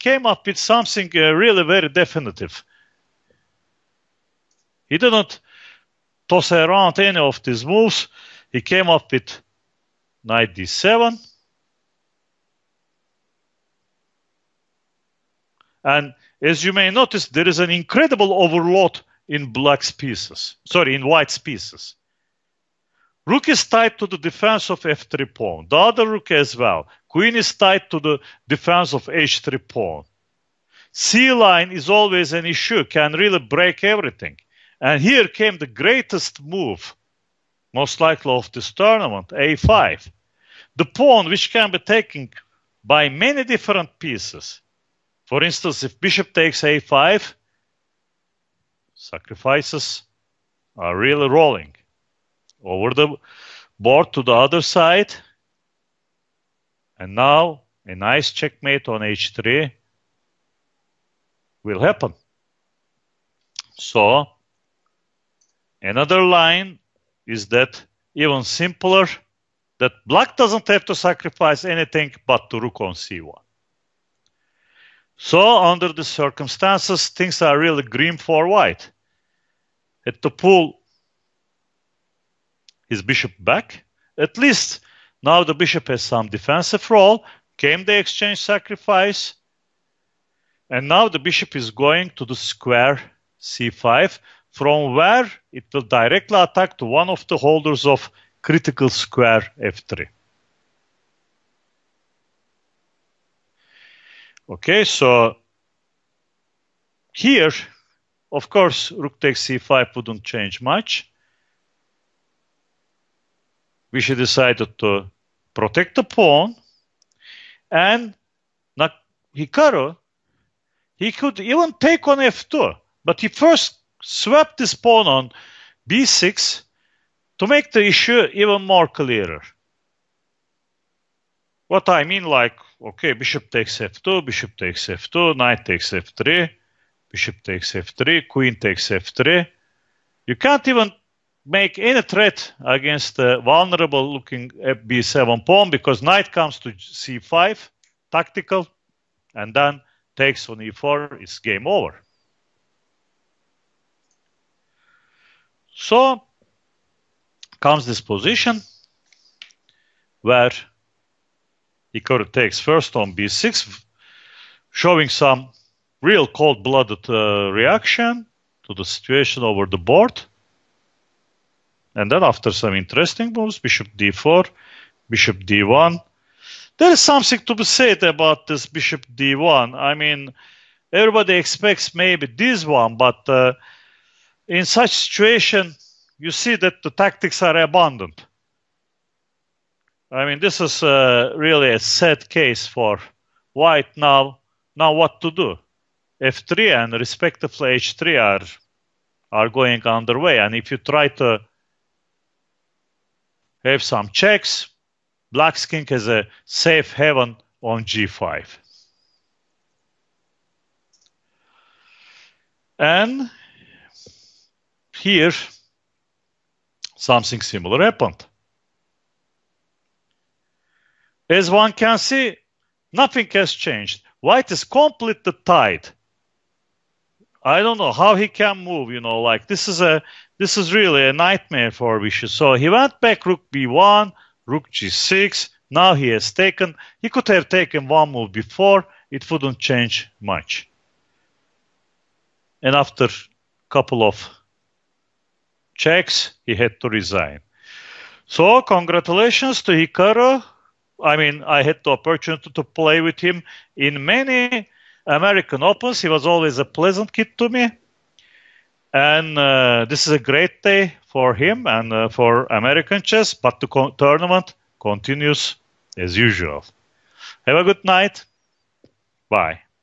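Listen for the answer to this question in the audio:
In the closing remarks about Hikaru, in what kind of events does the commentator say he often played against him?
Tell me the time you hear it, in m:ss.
4:15.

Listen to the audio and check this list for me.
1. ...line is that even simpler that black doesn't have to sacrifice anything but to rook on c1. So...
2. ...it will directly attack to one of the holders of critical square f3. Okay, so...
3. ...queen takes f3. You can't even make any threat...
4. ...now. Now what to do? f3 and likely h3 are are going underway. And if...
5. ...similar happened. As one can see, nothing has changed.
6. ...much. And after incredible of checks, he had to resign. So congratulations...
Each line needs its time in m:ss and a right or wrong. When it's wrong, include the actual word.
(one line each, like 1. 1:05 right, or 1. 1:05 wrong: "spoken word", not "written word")
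1. 1:06 right
2. 1:35 right
3. 2:18 right
4. 3:13 wrong: "respectively", not "likely"
5. 3:37 right
6. 4:00 wrong: "couple", not "incredible".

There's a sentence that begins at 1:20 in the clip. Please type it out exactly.
At the pool, his bishop back.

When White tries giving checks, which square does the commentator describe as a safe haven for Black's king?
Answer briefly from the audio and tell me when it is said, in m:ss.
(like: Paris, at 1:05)
g5, at 3:27.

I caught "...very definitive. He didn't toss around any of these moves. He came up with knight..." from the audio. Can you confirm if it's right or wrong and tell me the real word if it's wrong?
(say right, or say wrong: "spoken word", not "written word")
right.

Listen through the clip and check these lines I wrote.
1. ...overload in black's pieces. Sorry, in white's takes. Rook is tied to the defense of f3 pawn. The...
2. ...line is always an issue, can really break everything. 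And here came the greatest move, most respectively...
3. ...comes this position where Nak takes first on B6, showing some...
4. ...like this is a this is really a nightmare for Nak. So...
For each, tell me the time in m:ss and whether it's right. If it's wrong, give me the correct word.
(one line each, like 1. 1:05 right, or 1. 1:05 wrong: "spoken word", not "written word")
1. 0:18 wrong: "pieces", not "takes"
2. 0:31 wrong: "likely", not "respectively"
3. 2:37 wrong: "Hikaru", not "Nak"
4. 3:49 wrong: "Vishy", not "Nak".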